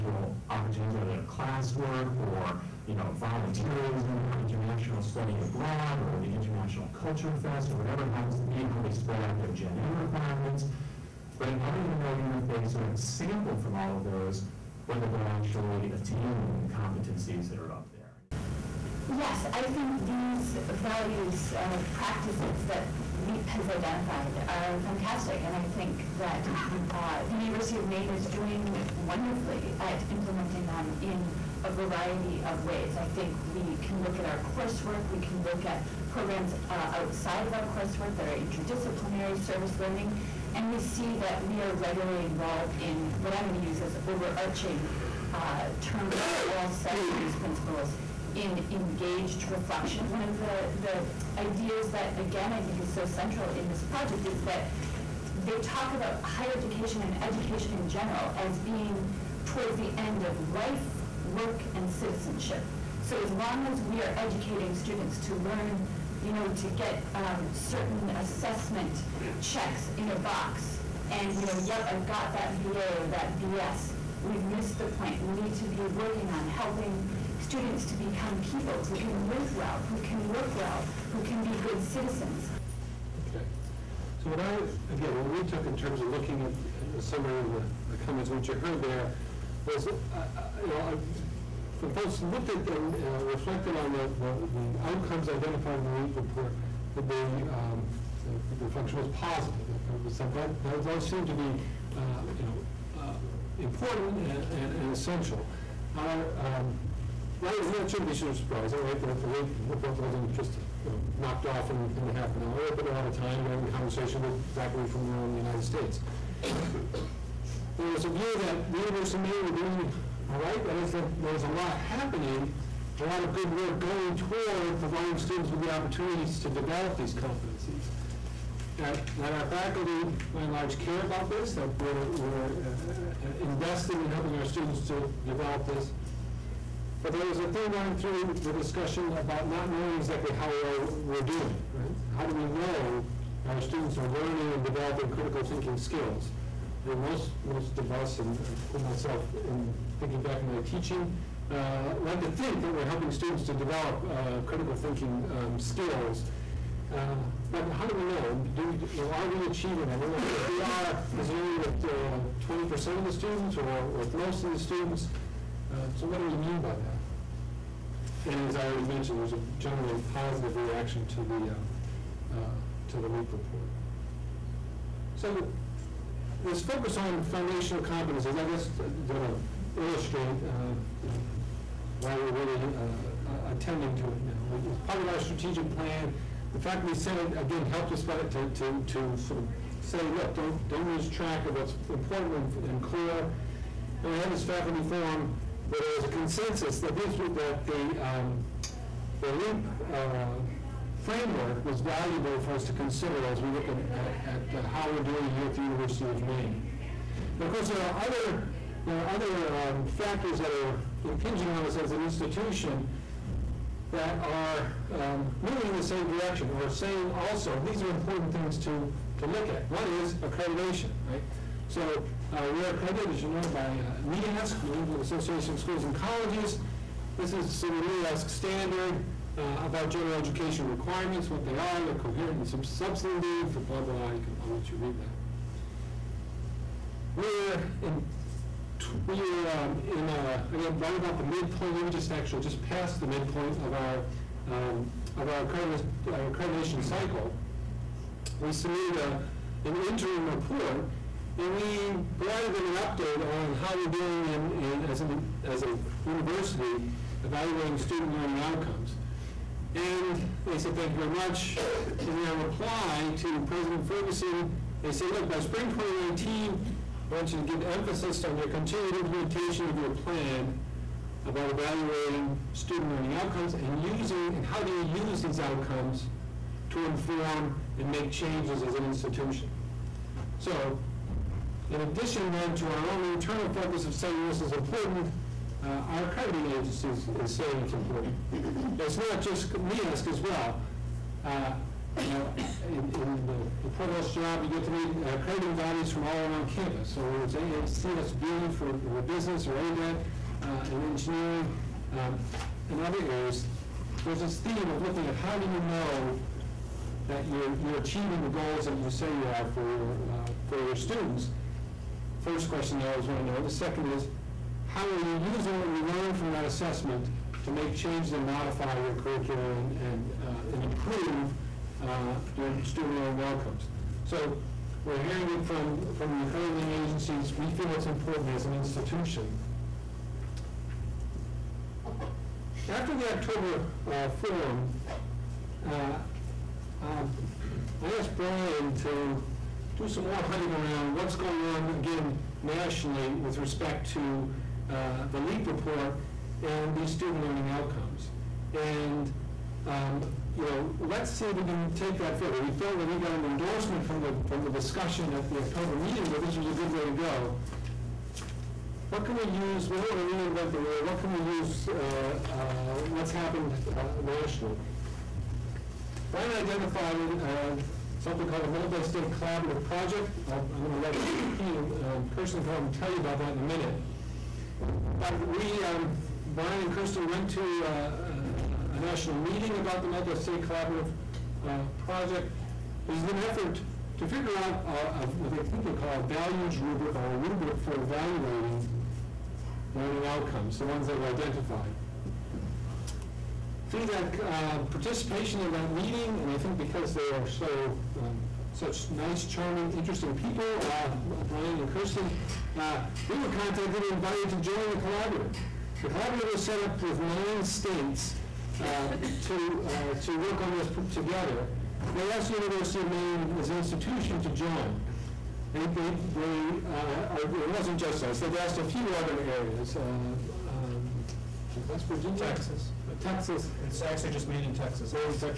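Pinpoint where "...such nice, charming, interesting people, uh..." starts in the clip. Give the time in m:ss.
6:38.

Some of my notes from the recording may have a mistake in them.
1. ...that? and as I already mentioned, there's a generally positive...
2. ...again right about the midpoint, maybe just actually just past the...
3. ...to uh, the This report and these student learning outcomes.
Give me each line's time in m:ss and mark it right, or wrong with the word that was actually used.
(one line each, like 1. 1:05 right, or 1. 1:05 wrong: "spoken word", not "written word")
1. 2:46 right
2. 4:00 right
3. 5:43 wrong: "LEAP", not "This".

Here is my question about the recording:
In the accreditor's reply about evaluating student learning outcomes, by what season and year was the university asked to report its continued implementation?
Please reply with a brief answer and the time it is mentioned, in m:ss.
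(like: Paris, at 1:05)
spring 2019, at 4:25.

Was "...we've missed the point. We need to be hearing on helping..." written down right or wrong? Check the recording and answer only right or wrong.
wrong.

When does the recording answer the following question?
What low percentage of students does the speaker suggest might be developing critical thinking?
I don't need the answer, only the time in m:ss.
2:41.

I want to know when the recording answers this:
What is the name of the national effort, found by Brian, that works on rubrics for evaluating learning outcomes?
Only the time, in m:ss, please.
6:08.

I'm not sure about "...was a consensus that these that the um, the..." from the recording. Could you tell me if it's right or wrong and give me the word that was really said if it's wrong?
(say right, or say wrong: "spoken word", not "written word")
right.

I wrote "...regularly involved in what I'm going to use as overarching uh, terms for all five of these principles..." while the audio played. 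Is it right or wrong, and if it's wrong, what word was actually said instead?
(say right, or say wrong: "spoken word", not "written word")
wrong: "seven", not "five".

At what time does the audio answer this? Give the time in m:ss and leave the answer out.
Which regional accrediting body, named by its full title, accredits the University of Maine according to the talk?
3:44.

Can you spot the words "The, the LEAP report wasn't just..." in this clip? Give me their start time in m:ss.
1:49.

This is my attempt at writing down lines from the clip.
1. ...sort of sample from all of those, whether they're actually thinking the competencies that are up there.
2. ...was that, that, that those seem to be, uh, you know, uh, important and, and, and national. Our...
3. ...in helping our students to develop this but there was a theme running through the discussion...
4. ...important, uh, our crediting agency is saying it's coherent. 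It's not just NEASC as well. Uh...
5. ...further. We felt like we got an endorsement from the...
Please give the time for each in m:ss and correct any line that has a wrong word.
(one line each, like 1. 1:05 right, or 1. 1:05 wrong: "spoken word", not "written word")
1. 0:12 wrong: "attaining", not "thinking"
2. 1:40 wrong: "essential", not "national"
3. 2:14 right
4. 4:44 wrong: "important", not "coherent"
5. 5:52 right.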